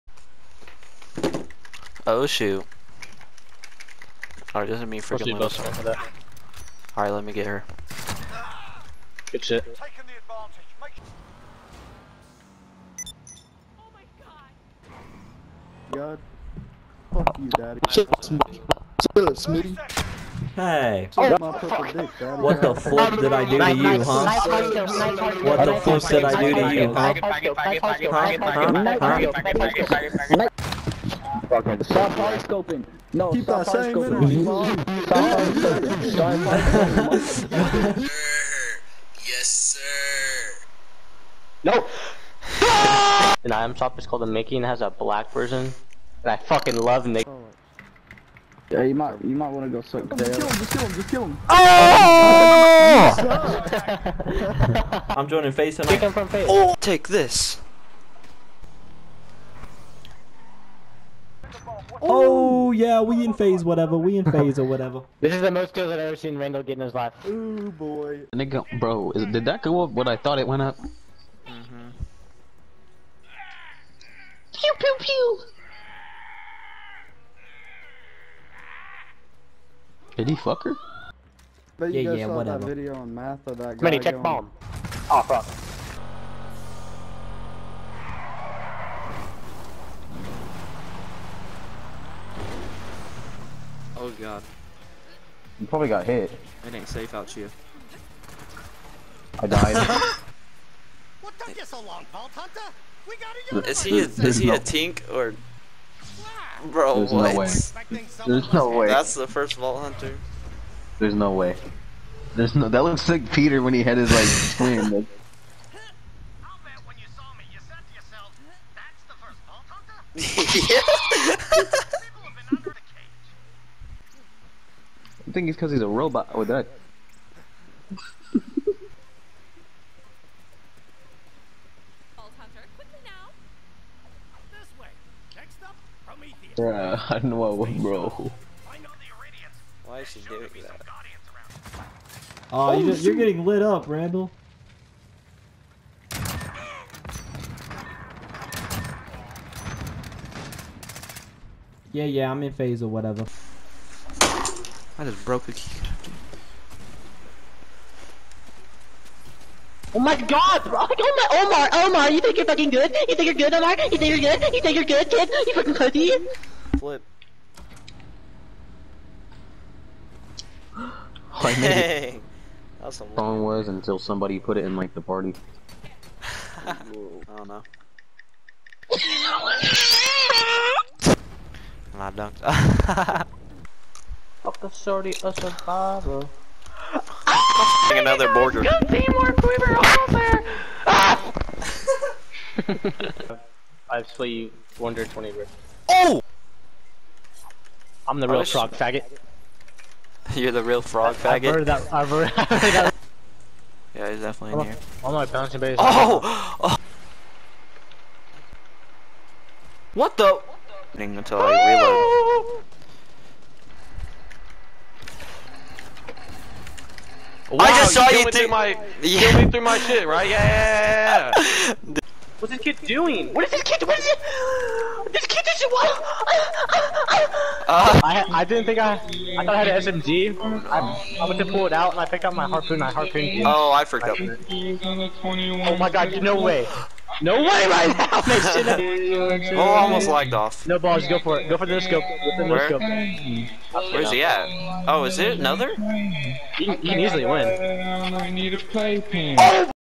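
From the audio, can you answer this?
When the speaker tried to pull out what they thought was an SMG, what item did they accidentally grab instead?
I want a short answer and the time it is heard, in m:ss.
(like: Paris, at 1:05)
Harpoon, at 3:52.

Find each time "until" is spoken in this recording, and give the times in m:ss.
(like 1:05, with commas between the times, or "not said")
2:53, 3:31.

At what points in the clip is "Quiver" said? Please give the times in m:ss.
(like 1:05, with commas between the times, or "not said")
3:08.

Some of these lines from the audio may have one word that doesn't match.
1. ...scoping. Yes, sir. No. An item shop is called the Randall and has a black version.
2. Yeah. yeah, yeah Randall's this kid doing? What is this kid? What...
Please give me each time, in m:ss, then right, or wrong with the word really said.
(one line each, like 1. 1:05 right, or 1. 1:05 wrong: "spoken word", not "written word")
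1. 0:37 wrong: "Mickey", not "Randall"
2. 3:40 wrong: "What", not "Randall".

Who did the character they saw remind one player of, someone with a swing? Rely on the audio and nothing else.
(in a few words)
Peter.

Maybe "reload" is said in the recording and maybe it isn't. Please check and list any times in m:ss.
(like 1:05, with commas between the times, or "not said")
3:31.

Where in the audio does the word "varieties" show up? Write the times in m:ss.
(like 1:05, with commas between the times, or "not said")
not said.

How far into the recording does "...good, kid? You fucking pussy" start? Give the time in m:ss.
2:44.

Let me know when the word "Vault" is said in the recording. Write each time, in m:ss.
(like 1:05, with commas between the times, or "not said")
1:42, 1:49.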